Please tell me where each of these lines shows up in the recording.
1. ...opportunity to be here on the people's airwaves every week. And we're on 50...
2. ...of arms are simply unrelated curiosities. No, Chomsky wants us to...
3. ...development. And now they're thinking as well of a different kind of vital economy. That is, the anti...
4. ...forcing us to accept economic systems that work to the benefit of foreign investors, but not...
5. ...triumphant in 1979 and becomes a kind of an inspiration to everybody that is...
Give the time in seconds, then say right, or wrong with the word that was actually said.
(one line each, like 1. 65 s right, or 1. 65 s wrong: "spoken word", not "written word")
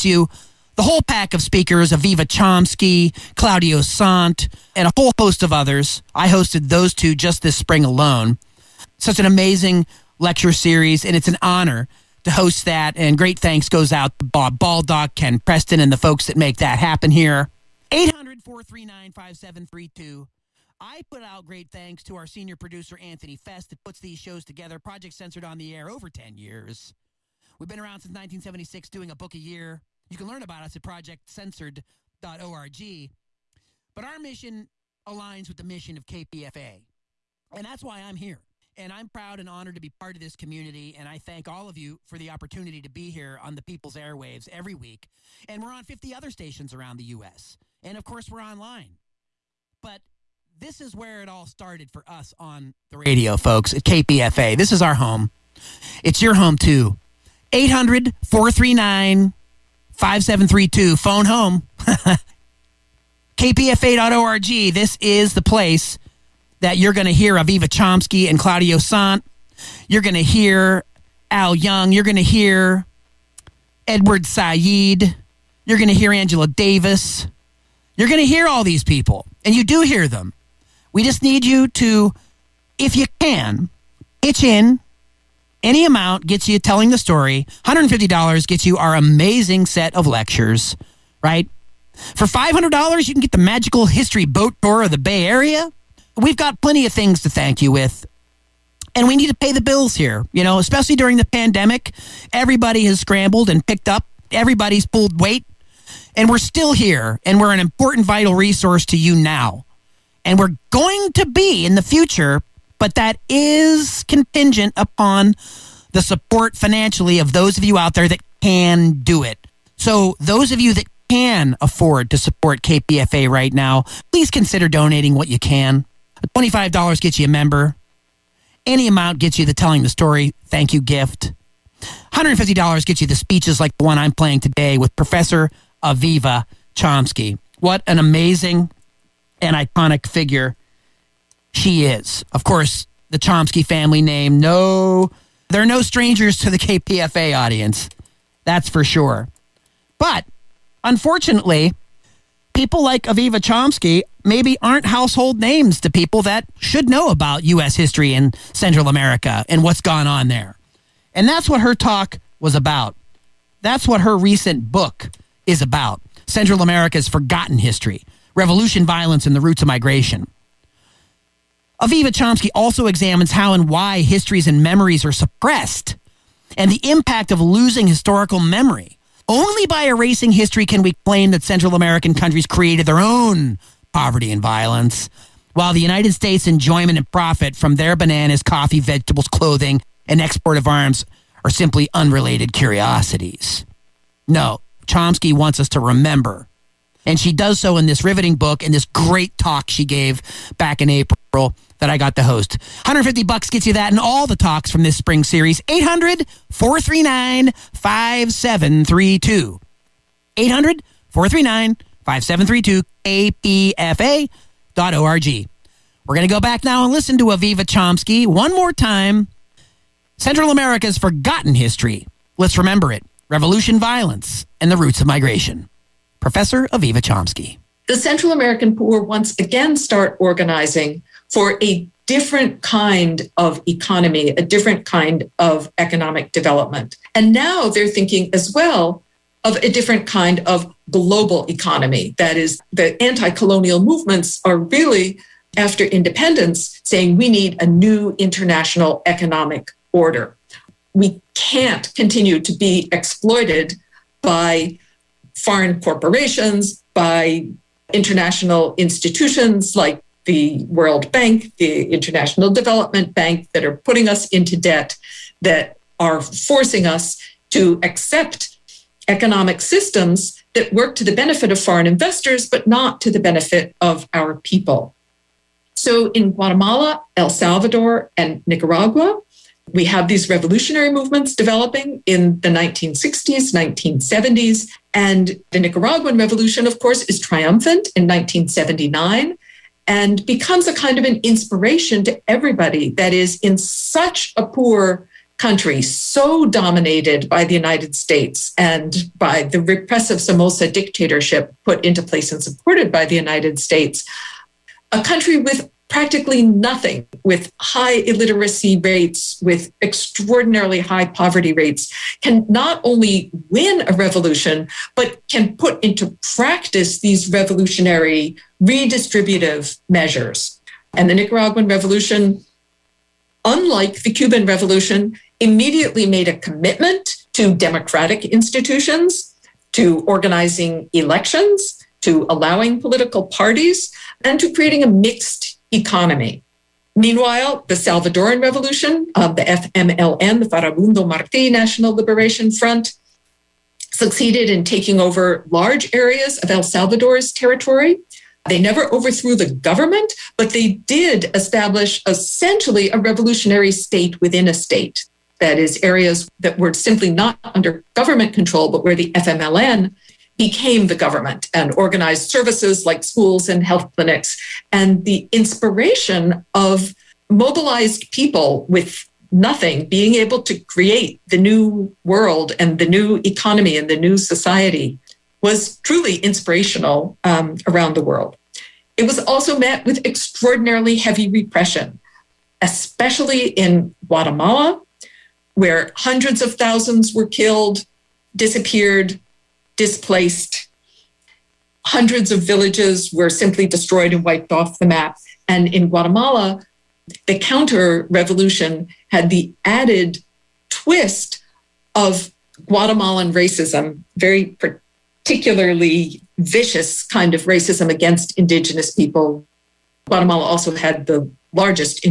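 1. 42 s right
2. 190 s right
3. 236 s wrong: "global", not "vital"
4. 266 s right
5. 287 s right.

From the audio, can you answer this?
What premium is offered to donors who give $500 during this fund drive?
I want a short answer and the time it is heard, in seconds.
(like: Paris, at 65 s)
magical history boat tour, at 93 s.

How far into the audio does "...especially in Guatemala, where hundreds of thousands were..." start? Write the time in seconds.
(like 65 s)
382 s.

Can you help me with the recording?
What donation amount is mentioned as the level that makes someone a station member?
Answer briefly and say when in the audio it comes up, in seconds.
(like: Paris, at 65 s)
$25, at 126 s.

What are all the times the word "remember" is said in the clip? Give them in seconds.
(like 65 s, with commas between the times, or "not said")
195 s, 222 s.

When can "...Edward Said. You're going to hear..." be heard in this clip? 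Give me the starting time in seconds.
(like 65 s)
73 s.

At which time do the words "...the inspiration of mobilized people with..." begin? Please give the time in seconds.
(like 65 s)
365 s.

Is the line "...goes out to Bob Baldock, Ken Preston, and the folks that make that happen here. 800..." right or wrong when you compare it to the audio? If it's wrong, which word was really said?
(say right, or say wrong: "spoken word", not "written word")
right.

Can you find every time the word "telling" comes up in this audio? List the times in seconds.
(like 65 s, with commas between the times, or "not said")
86 s, 129 s.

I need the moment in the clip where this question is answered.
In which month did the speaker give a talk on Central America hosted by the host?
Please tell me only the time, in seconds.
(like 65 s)
200 s.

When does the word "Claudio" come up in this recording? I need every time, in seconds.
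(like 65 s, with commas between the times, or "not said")
3 s, 68 s.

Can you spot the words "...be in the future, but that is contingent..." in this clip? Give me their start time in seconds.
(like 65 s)
111 s.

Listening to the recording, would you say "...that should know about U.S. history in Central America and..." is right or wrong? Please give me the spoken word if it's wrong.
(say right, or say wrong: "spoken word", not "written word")
right.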